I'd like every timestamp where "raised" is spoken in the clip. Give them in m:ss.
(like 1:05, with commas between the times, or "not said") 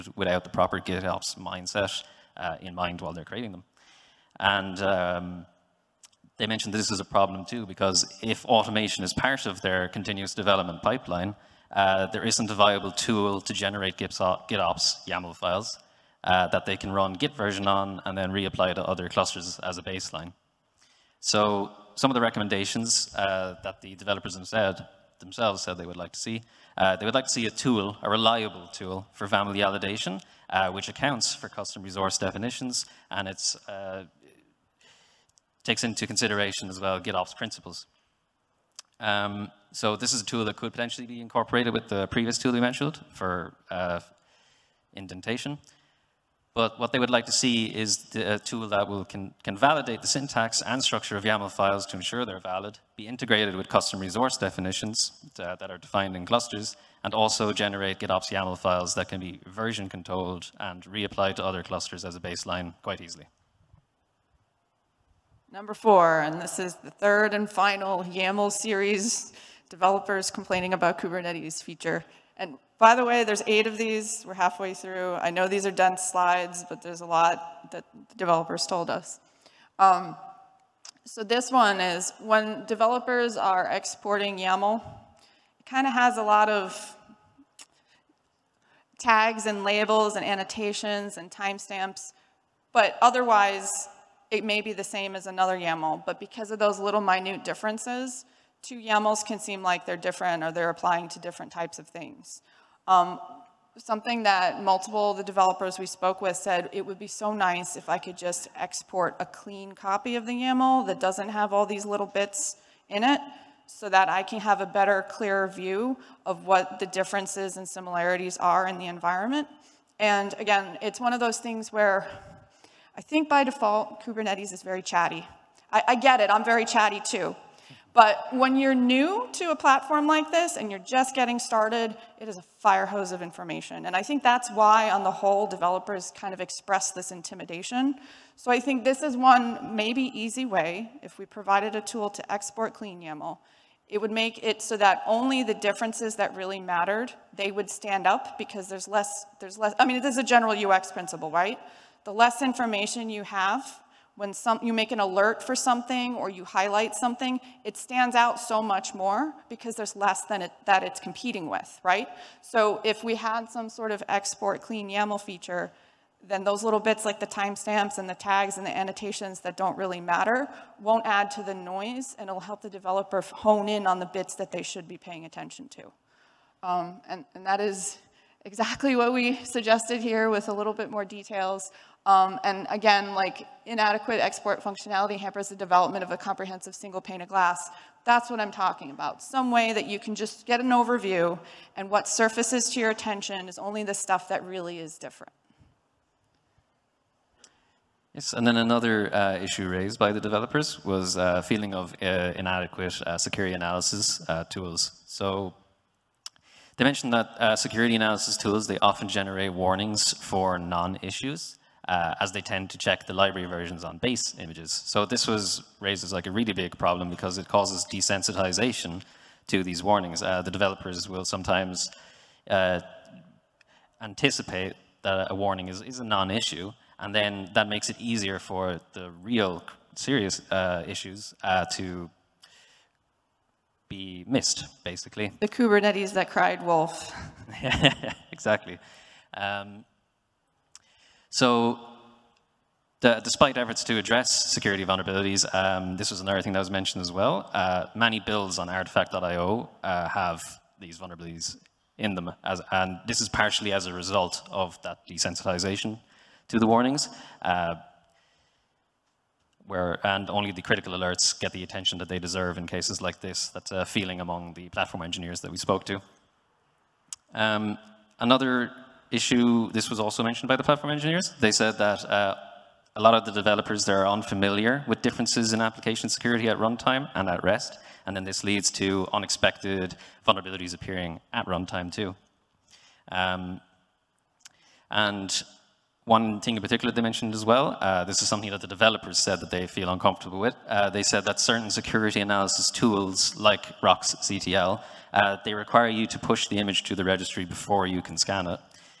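3:19, 3:35.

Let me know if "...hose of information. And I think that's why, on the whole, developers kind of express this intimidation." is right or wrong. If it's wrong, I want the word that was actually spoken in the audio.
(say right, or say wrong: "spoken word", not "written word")
right.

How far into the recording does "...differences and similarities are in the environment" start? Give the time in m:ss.
1:56.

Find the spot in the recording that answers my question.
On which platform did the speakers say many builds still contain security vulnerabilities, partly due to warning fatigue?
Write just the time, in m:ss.
4:08.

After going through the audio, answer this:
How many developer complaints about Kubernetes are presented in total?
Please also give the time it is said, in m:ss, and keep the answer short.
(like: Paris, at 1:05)
8, at 1:13.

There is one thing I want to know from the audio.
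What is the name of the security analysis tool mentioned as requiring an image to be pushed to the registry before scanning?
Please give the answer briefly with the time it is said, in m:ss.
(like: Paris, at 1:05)
roxctl, at 4:53.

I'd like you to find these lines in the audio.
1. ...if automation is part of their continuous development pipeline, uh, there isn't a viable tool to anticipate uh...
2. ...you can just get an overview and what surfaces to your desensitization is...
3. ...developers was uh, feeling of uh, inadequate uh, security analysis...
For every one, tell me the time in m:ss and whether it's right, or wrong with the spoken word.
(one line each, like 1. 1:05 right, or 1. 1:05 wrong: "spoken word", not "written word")
1. 0:08 wrong: "generate", not "anticipate"
2. 3:09 wrong: "attention", not "desensitization"
3. 3:20 right.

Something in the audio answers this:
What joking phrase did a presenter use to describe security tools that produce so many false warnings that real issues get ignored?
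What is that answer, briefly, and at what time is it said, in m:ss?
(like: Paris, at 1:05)
The Kubernetes that cried wolf, at 3:55.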